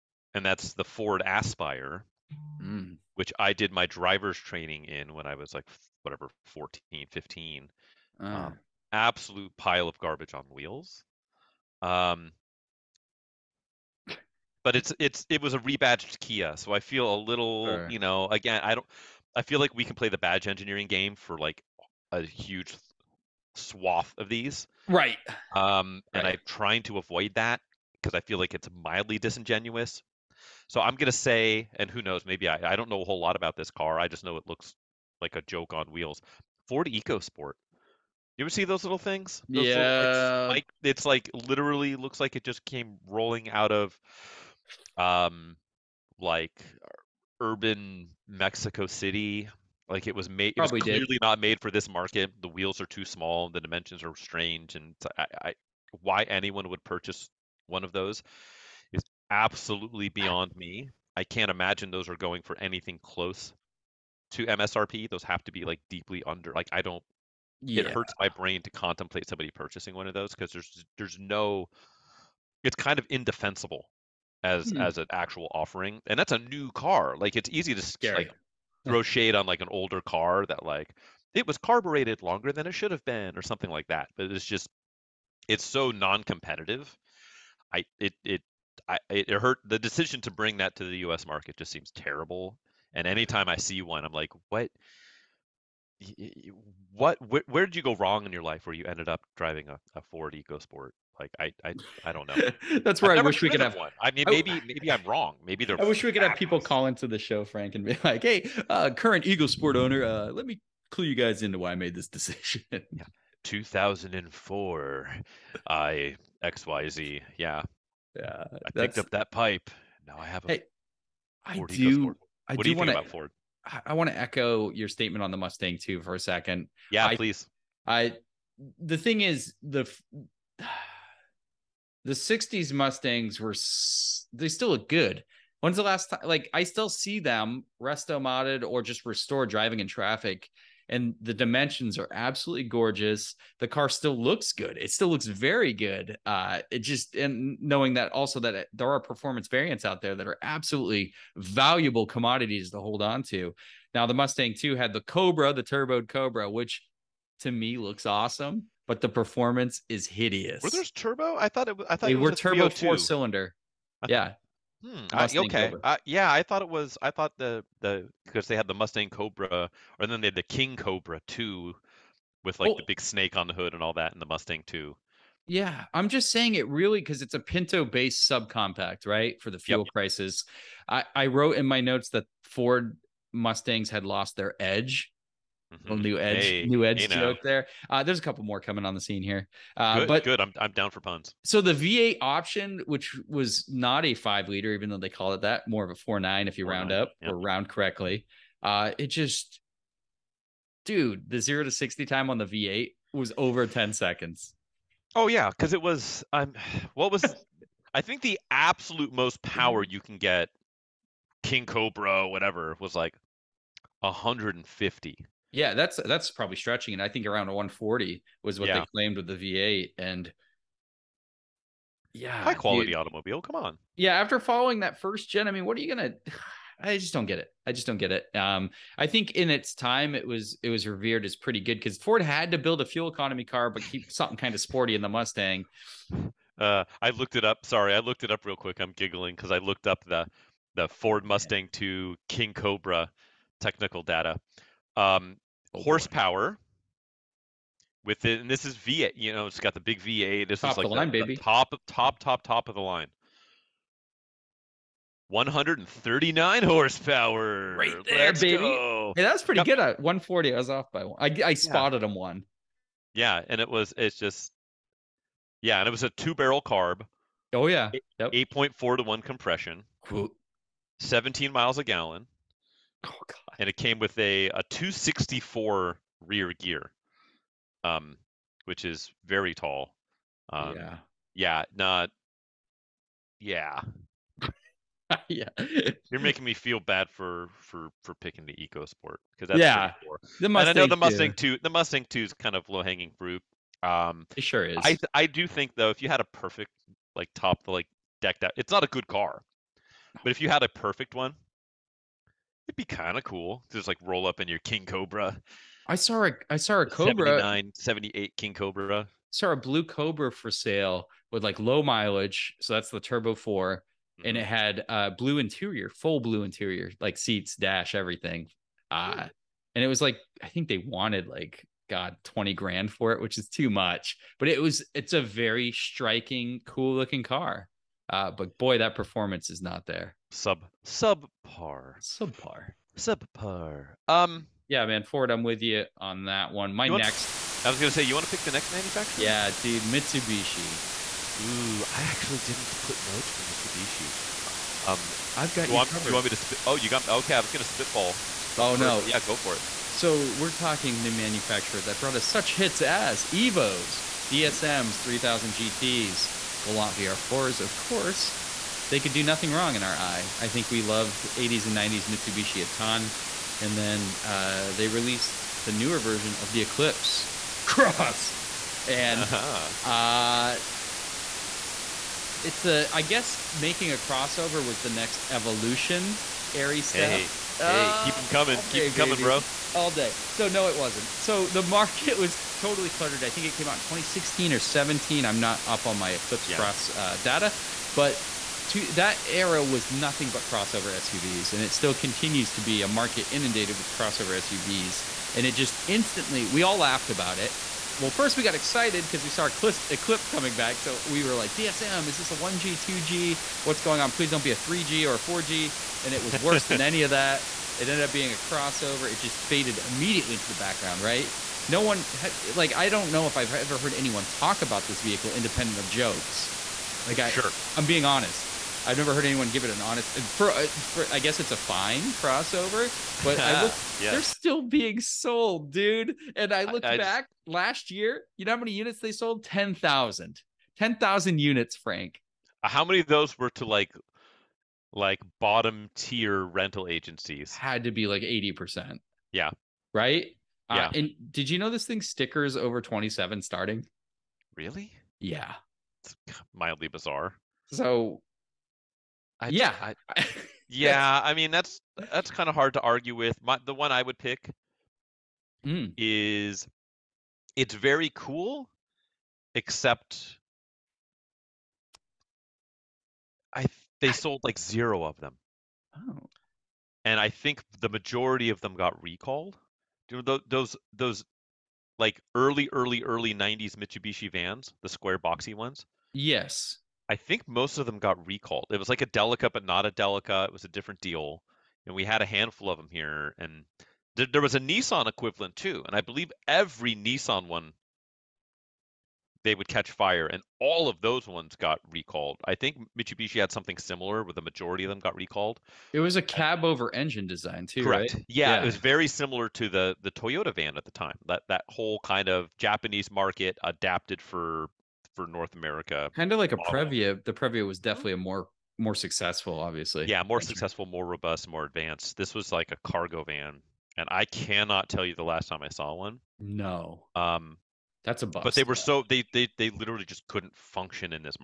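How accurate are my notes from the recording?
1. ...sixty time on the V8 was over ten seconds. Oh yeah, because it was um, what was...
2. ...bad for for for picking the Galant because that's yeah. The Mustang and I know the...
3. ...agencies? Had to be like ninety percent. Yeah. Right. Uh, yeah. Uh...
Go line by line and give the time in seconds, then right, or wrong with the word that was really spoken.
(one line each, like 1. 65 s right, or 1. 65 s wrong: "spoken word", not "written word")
1. 201 s right
2. 286 s wrong: "EcoSport", not "Galant"
3. 436 s wrong: "eighty", not "ninety".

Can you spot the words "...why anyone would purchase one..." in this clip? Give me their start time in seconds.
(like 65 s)
55 s.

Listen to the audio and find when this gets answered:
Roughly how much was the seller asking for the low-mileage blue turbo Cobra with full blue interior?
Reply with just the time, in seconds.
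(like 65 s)
322 s.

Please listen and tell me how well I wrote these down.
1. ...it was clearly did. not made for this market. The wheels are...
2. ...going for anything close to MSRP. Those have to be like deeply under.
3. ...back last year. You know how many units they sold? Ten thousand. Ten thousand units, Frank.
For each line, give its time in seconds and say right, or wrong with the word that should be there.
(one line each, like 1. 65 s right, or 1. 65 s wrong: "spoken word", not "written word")
1. 50 s right
2. 62 s right
3. 426 s right.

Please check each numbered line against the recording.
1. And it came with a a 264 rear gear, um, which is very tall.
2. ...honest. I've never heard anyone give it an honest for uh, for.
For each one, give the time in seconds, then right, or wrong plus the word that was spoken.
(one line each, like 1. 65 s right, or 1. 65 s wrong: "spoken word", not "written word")
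1. 273 s right
2. 418 s right.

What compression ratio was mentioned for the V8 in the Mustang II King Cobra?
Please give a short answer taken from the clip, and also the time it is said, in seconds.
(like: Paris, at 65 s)
8.4 to 1, at 268 s.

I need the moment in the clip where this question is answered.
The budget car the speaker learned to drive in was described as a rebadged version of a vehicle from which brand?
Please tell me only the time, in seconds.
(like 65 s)
16 s.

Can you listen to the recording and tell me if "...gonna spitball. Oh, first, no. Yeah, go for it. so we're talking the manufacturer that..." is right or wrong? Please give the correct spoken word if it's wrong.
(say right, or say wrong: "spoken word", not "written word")
right.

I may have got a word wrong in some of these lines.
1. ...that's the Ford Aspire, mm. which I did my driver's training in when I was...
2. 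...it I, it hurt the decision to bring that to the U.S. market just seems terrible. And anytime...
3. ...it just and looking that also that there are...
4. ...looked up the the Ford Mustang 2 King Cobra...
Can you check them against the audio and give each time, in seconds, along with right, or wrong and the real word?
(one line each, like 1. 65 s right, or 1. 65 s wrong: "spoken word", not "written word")
1. 0 s right
2. 88 s right
3. 146 s wrong: "knowing", not "looking"
4. 239 s right.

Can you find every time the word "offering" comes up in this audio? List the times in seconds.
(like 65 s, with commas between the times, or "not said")
75 s.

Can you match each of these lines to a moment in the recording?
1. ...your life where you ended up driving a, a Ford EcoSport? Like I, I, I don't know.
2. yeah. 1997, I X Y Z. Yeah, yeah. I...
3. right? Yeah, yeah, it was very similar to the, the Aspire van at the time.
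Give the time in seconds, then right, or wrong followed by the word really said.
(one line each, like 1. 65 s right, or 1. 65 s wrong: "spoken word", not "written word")
1. 98 s right
2. 112 s wrong: "2004", not "1997"
3. 498 s wrong: "Toyota", not "Aspire".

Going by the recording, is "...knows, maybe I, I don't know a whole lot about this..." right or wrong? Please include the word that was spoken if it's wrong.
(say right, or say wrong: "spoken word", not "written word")
right.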